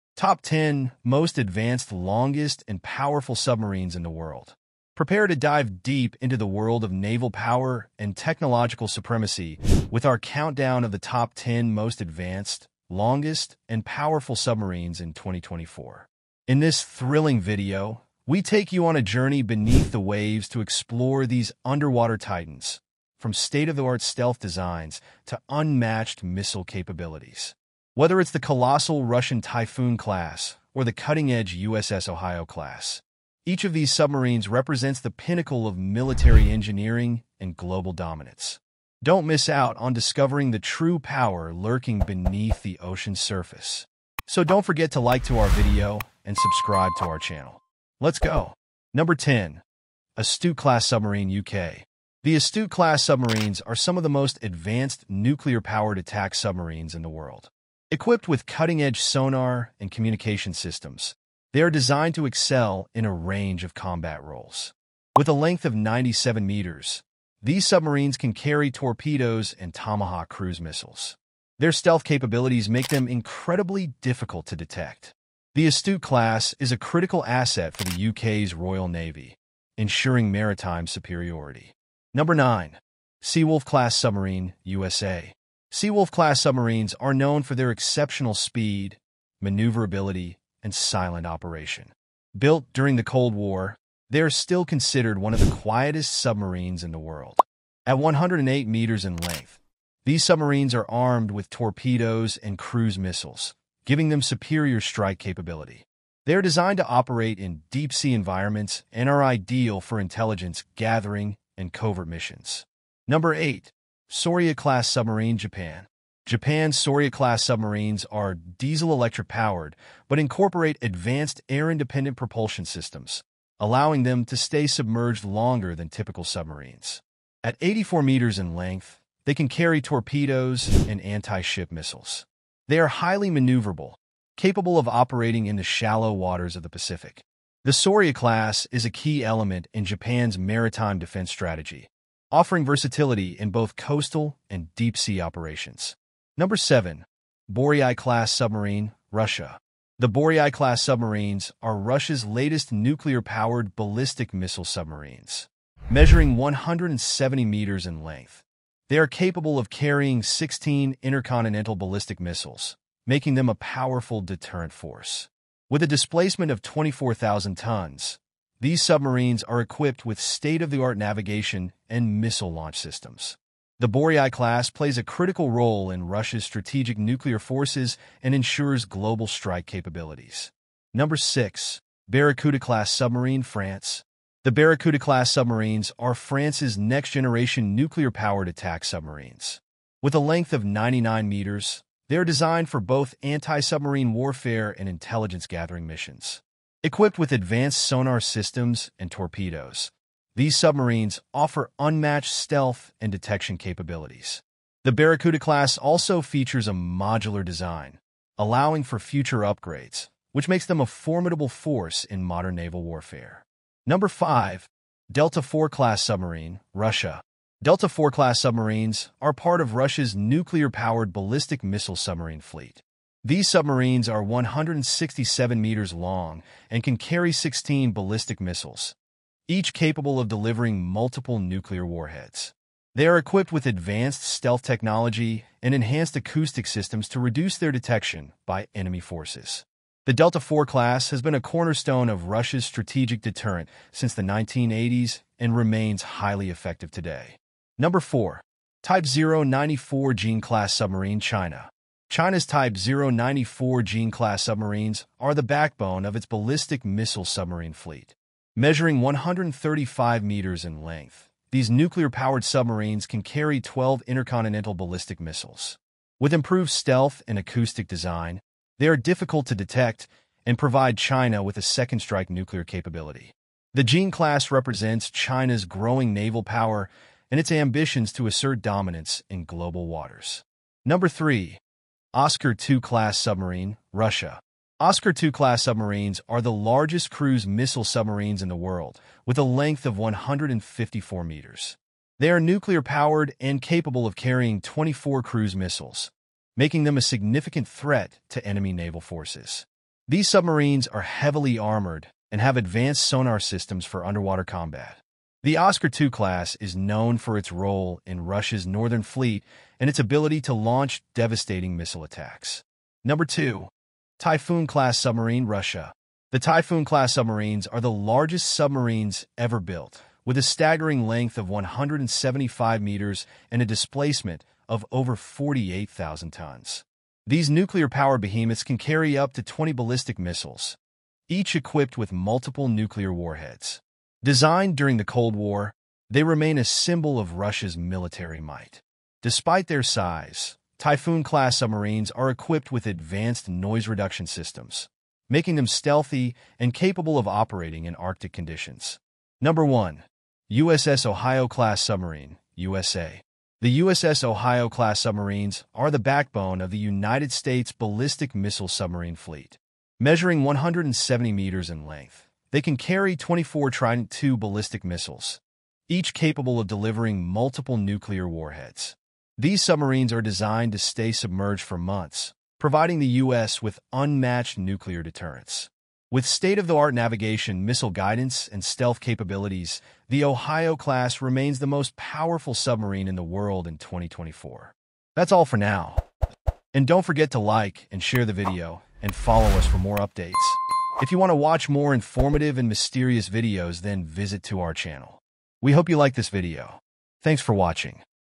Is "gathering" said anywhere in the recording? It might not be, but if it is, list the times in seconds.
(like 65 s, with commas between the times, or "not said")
110 s, 195 s.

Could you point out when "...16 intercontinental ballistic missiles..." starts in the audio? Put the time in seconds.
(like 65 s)
160 s.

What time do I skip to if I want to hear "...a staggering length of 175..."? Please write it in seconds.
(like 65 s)
320 s.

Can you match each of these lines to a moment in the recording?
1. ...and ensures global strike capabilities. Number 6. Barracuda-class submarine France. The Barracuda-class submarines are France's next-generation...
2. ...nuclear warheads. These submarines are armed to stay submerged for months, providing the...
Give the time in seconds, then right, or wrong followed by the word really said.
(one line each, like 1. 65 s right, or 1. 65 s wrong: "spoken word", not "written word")
1. 178 s right
2. 367 s wrong: "designed", not "armed".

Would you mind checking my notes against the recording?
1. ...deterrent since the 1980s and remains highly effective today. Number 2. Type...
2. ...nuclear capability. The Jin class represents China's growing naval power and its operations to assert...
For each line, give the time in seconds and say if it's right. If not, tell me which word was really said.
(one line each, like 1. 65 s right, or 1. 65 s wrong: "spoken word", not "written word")
1. 243 s wrong: "4", not "2"
2. 272 s wrong: "ambitions", not "operations".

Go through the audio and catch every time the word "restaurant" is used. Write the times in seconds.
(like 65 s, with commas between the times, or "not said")
not said.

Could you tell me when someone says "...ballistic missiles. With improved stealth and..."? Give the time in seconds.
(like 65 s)
264 s.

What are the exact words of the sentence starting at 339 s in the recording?
Despite their size, Typhoon-class submarines are equipped with advanced noise reduction systems, making them stealthy and capable of operating in Arctic conditions.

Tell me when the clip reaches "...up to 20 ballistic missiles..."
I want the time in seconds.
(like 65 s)
329 s.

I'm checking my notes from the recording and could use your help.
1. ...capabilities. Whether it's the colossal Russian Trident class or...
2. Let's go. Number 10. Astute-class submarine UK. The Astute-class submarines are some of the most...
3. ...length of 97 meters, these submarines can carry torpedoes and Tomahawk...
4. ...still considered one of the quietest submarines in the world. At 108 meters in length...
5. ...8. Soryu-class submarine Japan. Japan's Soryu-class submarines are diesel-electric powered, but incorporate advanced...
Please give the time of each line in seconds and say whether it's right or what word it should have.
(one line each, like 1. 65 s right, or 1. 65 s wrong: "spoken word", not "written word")
1. 26 s wrong: "Typhoon", not "Trident"
2. 47 s right
3. 65 s right
4. 94 s right
5. 113 s right.